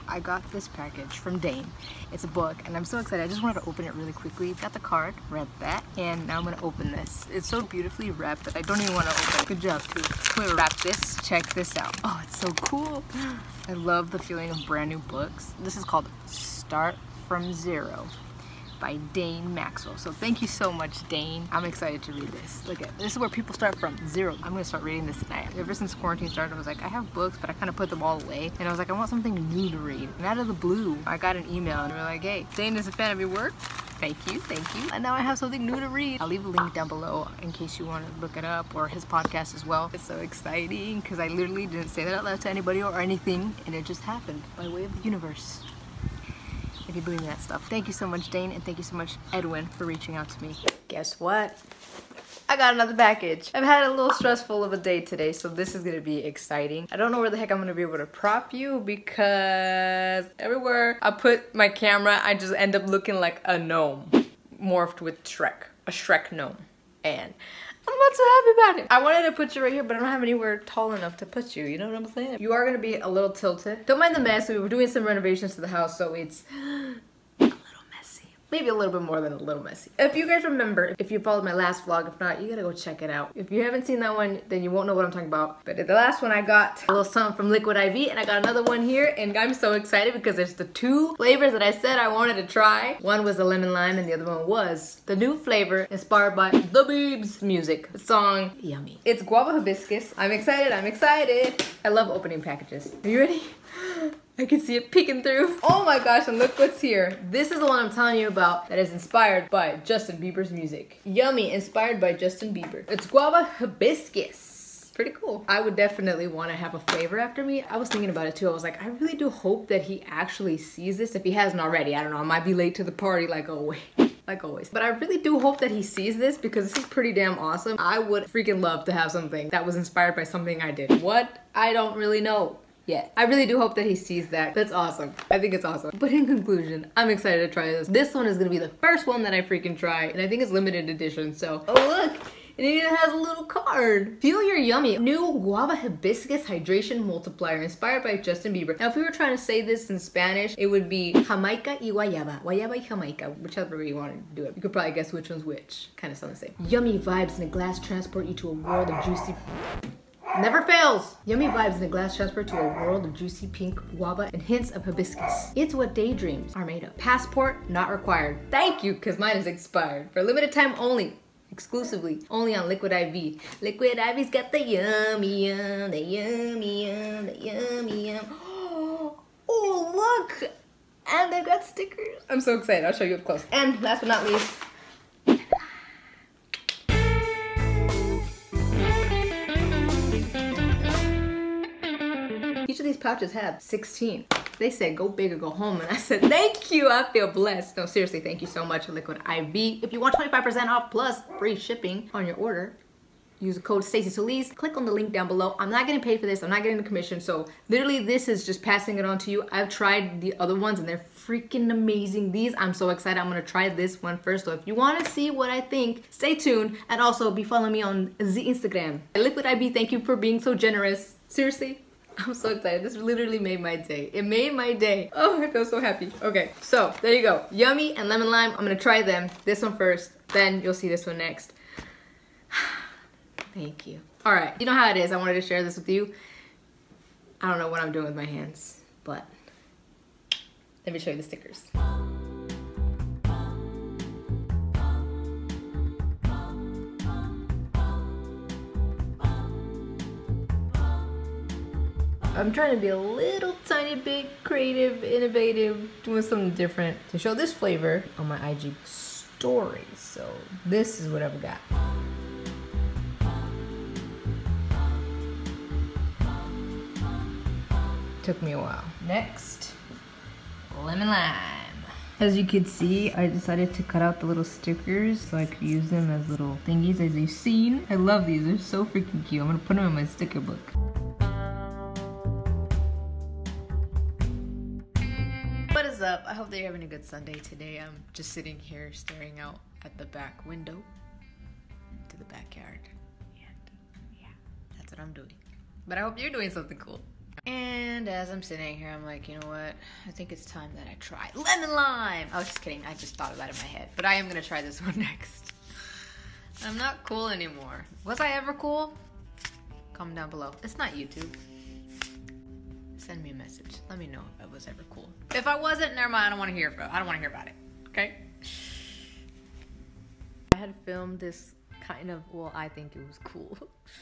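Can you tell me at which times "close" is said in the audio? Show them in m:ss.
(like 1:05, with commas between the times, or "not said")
3:03.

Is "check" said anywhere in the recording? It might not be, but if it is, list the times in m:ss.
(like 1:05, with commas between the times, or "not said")
0:11, 1:22.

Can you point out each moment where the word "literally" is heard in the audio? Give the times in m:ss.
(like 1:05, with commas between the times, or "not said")
0:41, 3:27, 3:42.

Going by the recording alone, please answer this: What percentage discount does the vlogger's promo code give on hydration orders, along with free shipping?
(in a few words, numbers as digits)
25%.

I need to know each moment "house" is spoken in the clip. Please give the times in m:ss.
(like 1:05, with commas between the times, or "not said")
1:15.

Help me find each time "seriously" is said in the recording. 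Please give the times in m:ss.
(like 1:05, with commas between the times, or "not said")
3:17, 3:41.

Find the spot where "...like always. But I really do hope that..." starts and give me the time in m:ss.
2:04.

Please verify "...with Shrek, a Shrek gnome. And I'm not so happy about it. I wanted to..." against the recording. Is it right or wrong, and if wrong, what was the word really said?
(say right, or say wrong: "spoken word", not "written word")
right.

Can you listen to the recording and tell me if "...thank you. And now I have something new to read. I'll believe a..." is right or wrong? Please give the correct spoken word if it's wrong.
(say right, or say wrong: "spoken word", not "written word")
wrong: "leave", not "believe".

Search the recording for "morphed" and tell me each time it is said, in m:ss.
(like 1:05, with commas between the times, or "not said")
1:04.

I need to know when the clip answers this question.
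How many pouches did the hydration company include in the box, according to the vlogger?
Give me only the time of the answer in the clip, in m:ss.
3:13.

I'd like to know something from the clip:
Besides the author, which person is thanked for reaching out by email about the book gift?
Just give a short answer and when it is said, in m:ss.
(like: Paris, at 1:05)
Edwin, at 0:49.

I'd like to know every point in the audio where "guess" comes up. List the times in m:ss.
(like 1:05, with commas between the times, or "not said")
0:50, 2:34.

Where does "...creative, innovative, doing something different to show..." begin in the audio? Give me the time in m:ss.
4:14.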